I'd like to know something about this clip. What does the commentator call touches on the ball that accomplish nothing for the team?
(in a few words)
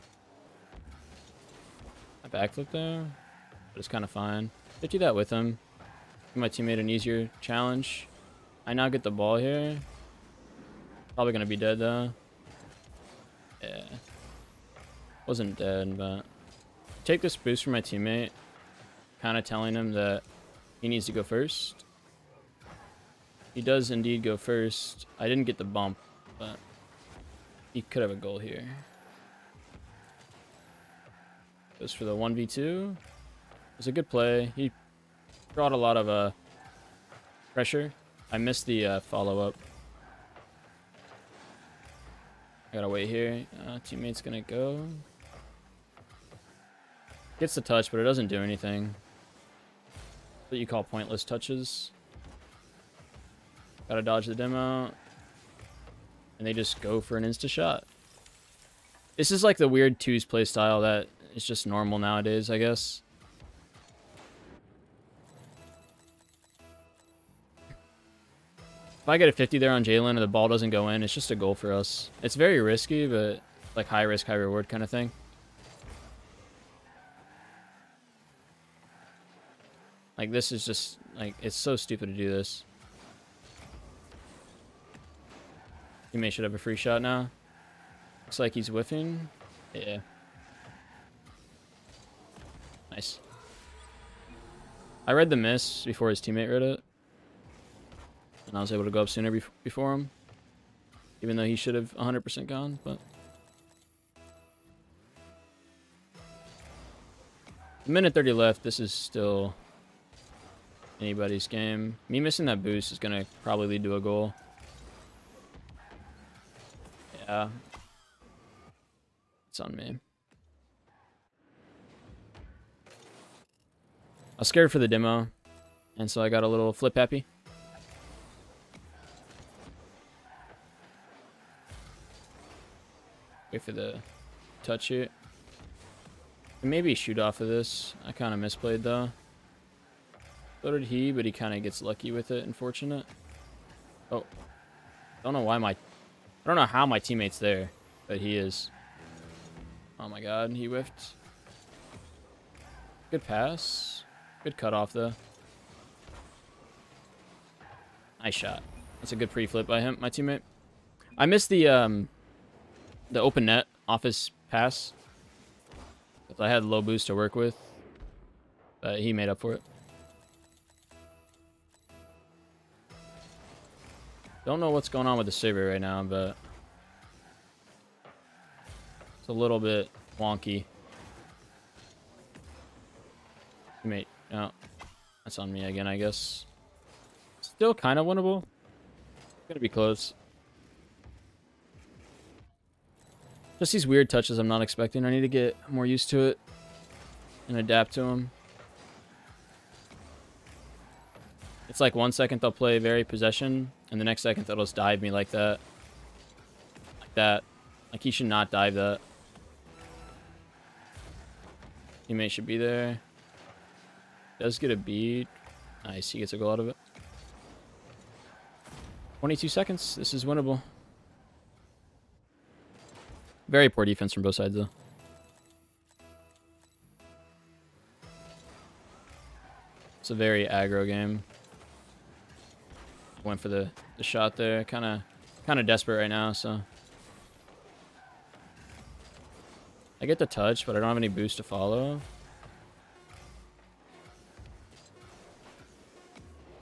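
pointless touches.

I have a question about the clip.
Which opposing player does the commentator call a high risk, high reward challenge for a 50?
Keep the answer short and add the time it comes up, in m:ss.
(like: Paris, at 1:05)
Jalen, at 1:09.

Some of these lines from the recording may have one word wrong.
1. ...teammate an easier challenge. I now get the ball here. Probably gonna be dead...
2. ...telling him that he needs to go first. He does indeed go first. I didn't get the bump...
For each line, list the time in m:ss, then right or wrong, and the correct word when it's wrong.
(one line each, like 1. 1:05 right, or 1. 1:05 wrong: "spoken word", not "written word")
1. 0:06 right
2. 0:19 right.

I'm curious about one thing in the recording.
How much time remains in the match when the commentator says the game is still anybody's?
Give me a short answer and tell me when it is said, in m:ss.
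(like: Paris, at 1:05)
A minute 30, at 1:47.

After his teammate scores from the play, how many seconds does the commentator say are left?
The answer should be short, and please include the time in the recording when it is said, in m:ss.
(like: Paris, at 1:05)
22 seconds, at 3:39.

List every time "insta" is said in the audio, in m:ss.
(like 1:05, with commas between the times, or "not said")
0:57.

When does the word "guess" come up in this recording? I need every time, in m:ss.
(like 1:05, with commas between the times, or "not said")
1:02, 3:05.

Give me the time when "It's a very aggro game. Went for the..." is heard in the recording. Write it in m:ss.
3:49.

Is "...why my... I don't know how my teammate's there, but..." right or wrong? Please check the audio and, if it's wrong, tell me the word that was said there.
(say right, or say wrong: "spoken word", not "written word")
right.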